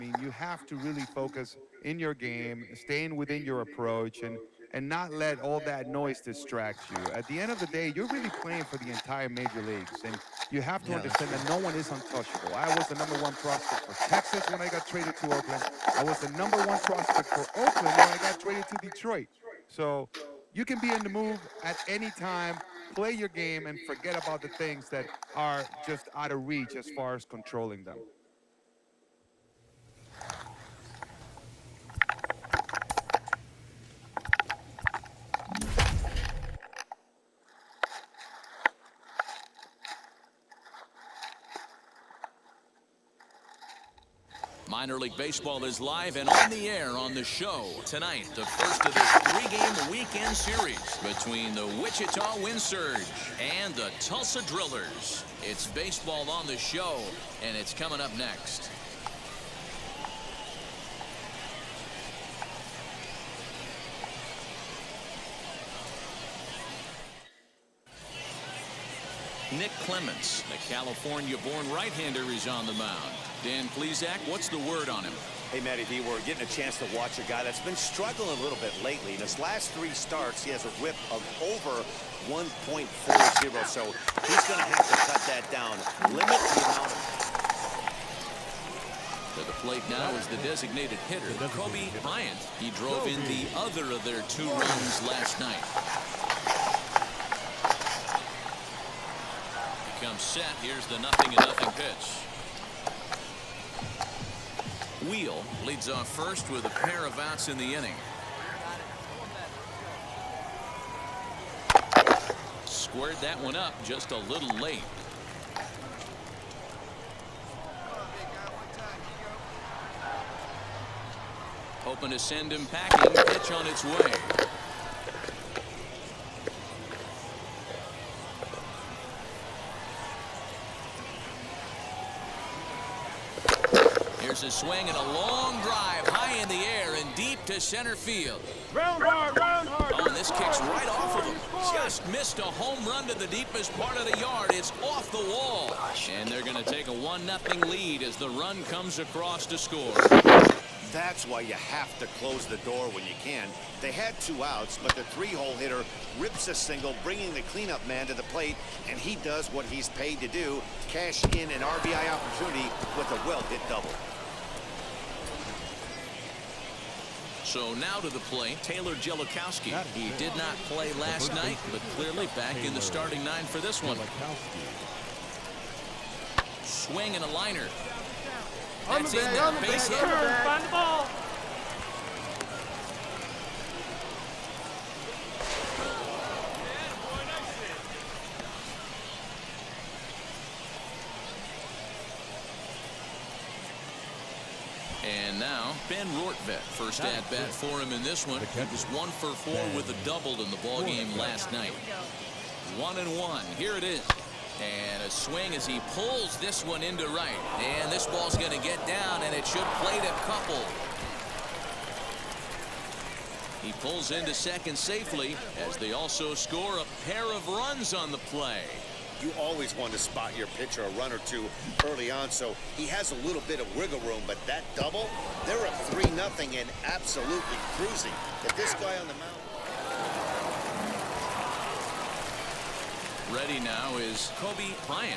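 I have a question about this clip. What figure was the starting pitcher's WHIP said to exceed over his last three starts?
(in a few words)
1.40.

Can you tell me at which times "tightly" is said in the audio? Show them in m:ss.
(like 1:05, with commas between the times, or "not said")
not said.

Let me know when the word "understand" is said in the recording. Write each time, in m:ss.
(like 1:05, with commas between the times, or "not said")
0:10.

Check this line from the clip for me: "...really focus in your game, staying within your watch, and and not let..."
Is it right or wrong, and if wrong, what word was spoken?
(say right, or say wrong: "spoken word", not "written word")
wrong: "approach", not "watch".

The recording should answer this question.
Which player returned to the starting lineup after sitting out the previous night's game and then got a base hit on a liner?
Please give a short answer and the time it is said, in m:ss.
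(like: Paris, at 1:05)
Taylor Grzelakowski, at 2:48.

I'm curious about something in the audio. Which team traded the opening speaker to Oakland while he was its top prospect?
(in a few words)
Texas.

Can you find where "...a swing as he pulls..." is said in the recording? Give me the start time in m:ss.
3:25.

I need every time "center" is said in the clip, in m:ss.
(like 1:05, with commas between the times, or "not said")
2:17.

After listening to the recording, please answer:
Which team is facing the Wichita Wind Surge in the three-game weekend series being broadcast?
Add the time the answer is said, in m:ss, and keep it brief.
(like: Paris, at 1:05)
Tulsa Drillers, at 0:53.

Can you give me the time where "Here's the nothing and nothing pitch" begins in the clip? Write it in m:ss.
1:40.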